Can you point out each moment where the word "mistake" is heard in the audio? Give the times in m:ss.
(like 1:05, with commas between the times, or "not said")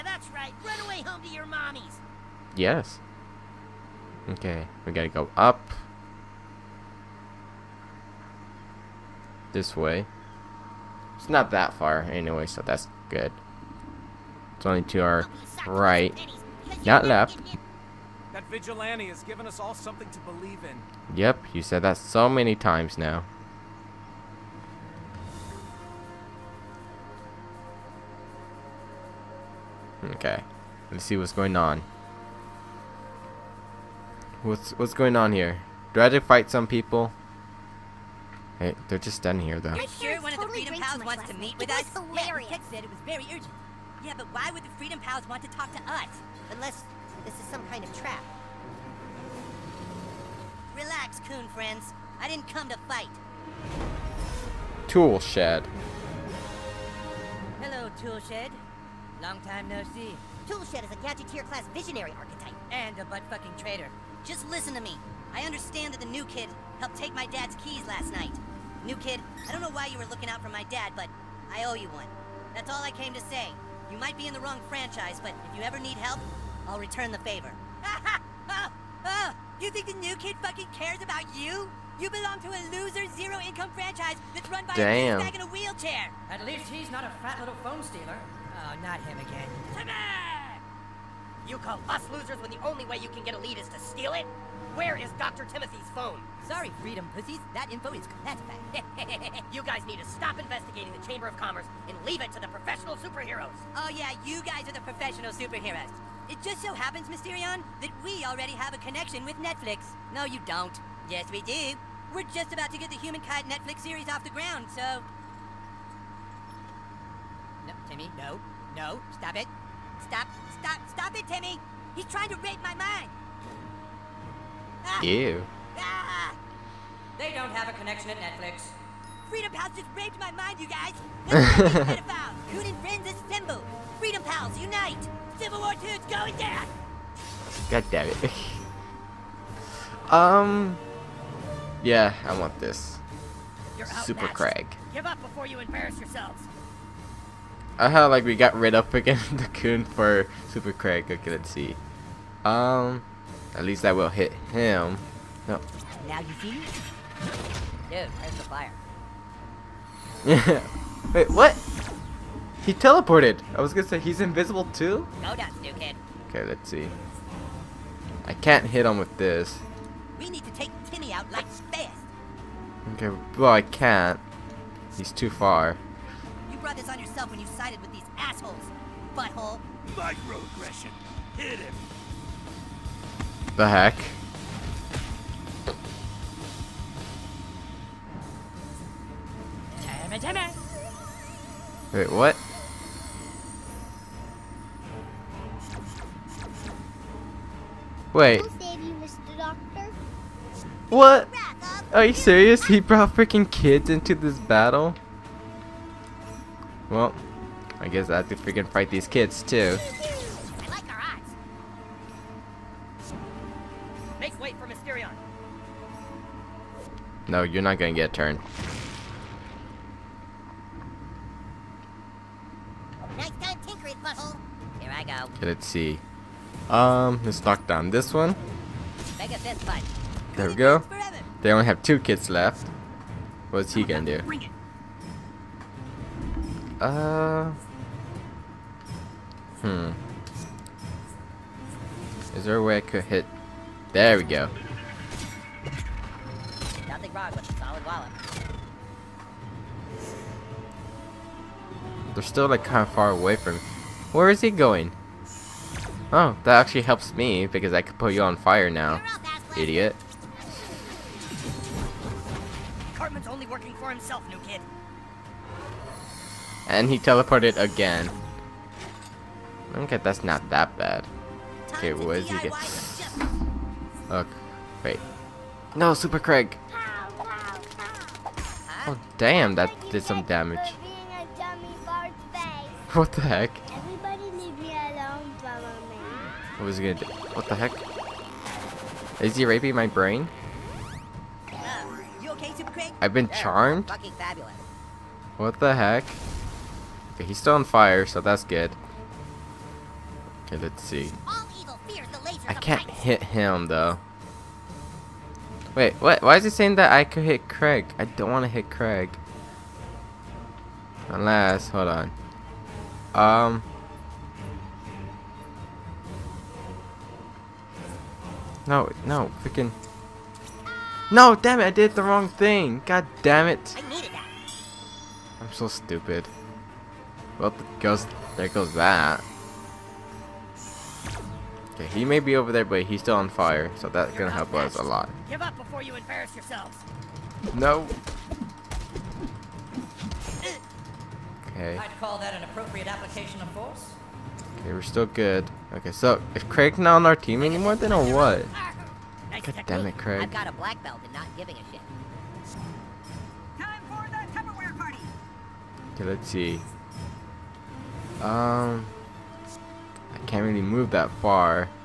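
not said.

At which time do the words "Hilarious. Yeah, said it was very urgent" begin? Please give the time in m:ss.
0:41.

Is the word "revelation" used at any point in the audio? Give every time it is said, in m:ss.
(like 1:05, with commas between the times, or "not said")
not said.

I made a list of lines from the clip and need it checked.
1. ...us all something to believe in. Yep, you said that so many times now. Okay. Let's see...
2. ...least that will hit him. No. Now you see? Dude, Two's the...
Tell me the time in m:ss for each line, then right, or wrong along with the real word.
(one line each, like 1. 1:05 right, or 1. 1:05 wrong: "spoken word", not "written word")
1. 0:19 right
2. 2:33 wrong: "There", not "Two".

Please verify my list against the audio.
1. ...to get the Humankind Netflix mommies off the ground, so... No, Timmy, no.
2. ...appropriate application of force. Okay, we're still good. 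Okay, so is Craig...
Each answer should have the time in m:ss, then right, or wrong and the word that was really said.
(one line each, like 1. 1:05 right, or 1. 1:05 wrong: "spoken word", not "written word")
1. 1:52 wrong: "series", not "mommies"
2. 5:42 right.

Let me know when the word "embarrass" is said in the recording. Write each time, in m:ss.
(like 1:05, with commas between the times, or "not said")
2:25, 5:35.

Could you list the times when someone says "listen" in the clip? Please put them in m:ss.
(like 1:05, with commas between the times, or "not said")
1:04.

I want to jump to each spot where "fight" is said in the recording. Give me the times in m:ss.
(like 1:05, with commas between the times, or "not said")
0:36, 0:52, 3:28.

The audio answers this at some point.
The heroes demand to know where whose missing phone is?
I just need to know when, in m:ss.
1:35.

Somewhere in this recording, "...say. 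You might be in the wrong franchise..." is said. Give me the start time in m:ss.
1:13.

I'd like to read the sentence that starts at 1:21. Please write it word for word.
You belong to a loser, zero-income franchise that's run by Damn.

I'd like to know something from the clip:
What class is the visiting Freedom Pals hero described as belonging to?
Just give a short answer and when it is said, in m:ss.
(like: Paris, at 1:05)
Gadgeteer, at 1:00.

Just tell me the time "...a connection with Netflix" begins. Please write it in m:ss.
1:48.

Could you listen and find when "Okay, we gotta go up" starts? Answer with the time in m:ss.
0:04.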